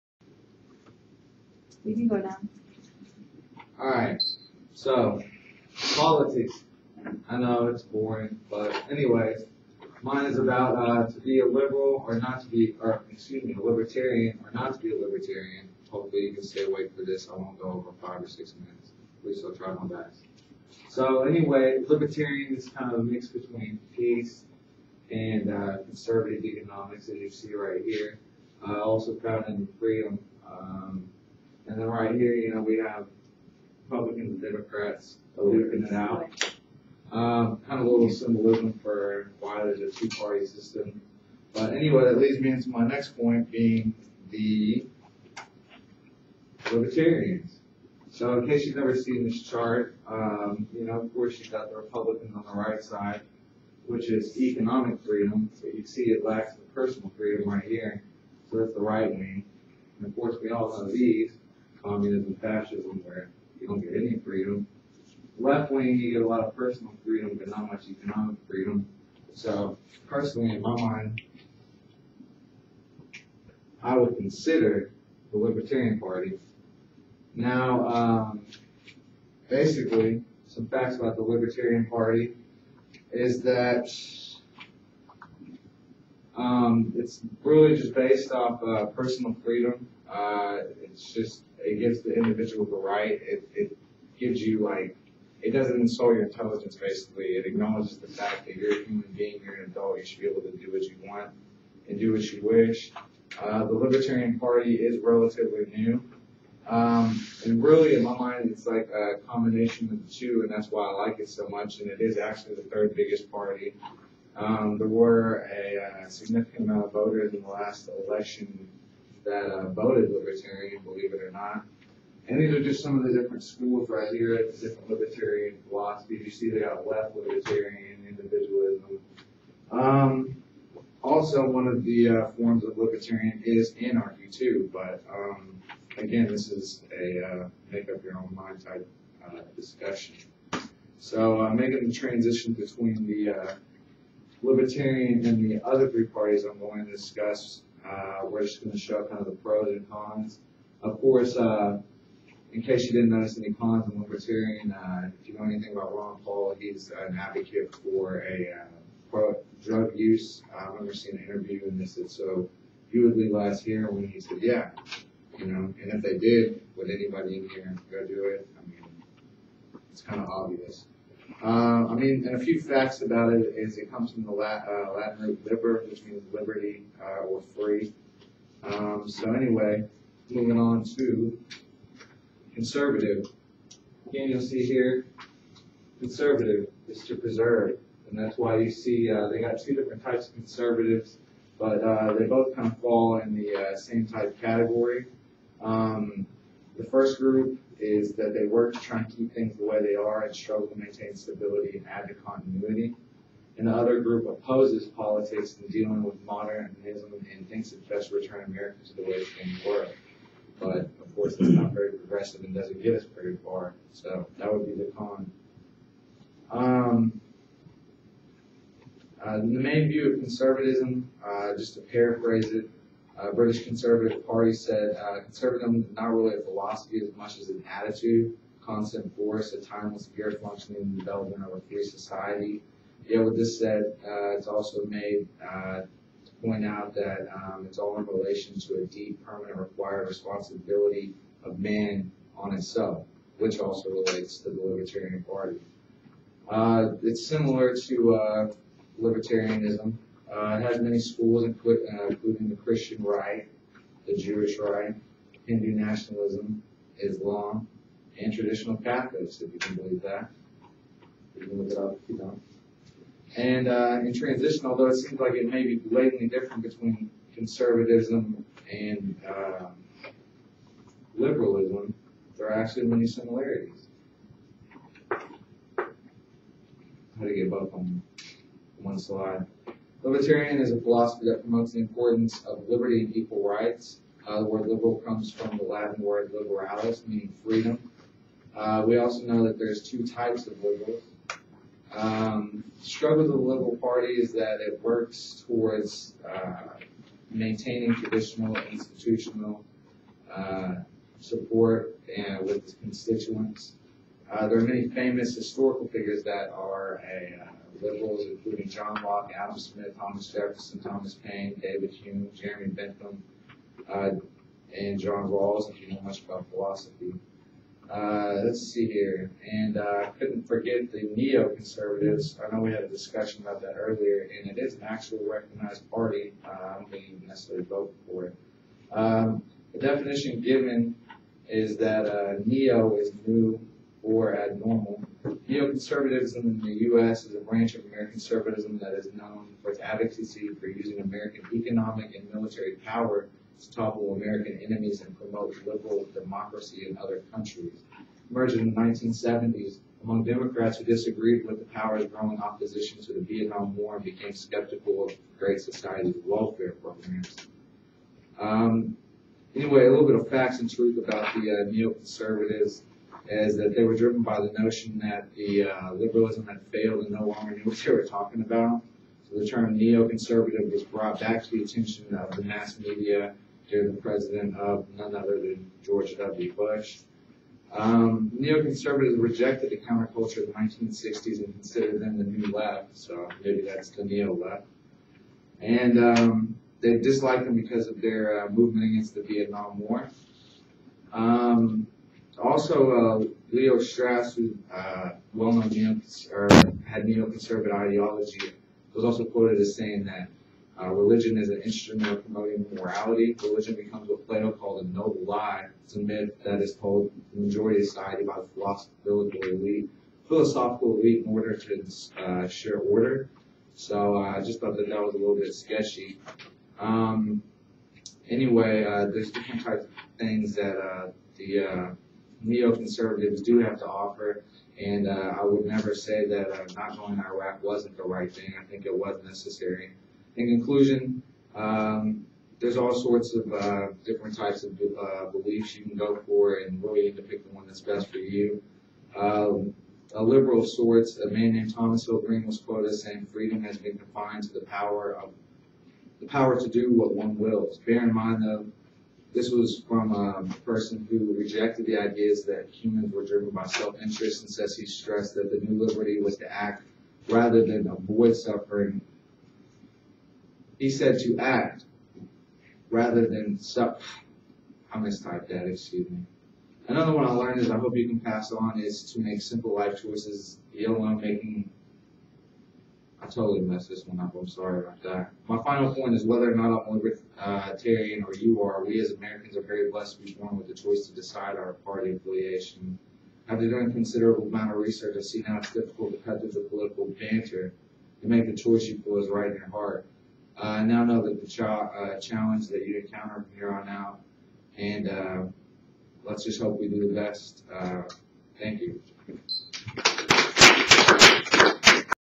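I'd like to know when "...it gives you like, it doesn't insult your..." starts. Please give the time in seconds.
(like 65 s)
93 s.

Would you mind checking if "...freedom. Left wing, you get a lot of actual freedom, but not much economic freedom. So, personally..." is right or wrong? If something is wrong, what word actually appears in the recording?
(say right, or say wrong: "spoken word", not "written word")
wrong: "personal", not "actual".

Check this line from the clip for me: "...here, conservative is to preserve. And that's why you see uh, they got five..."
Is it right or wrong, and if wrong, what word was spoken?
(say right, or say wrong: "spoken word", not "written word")
wrong: "two", not "five".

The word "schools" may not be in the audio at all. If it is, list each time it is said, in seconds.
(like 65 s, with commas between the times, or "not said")
123 s, 250 s.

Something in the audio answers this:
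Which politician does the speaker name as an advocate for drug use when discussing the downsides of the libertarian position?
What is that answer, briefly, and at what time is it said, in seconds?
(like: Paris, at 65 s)
Ron Paul, at 155 s.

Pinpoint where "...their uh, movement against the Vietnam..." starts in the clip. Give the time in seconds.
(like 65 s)
388 s.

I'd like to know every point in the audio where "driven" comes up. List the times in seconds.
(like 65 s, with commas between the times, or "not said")
363 s, 453 s.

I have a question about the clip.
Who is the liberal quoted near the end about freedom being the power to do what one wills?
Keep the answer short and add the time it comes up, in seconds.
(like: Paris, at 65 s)
Thomas Hill Green, at 441 s.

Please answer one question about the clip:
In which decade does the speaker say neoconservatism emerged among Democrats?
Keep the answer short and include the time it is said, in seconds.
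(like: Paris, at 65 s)
1970s, at 348 s.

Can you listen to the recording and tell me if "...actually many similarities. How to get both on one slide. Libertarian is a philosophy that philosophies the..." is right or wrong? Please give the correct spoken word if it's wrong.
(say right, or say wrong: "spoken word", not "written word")
wrong: "promotes", not "philosophies".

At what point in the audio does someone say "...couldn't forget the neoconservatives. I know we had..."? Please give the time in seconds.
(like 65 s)
320 s.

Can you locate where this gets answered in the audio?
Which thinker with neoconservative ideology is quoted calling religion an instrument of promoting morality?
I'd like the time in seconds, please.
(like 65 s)
393 s.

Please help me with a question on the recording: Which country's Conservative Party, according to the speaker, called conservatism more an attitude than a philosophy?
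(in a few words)
British.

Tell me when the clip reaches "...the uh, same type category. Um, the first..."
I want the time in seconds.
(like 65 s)
193 s.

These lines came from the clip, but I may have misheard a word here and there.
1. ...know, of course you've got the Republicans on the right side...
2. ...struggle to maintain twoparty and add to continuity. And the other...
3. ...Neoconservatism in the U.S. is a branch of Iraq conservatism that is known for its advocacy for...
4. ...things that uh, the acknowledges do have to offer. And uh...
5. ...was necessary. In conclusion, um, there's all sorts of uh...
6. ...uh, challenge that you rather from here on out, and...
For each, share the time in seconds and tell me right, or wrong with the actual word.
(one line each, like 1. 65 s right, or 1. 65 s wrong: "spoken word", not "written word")
1. 50 s right
2. 200 s wrong: "stability", not "twoparty"
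3. 335 s wrong: "American", not "Iraq"
4. 420 s wrong: "neoconservatives", not "acknowledges"
5. 428 s right
6. 491 s wrong: "encounter", not "rather".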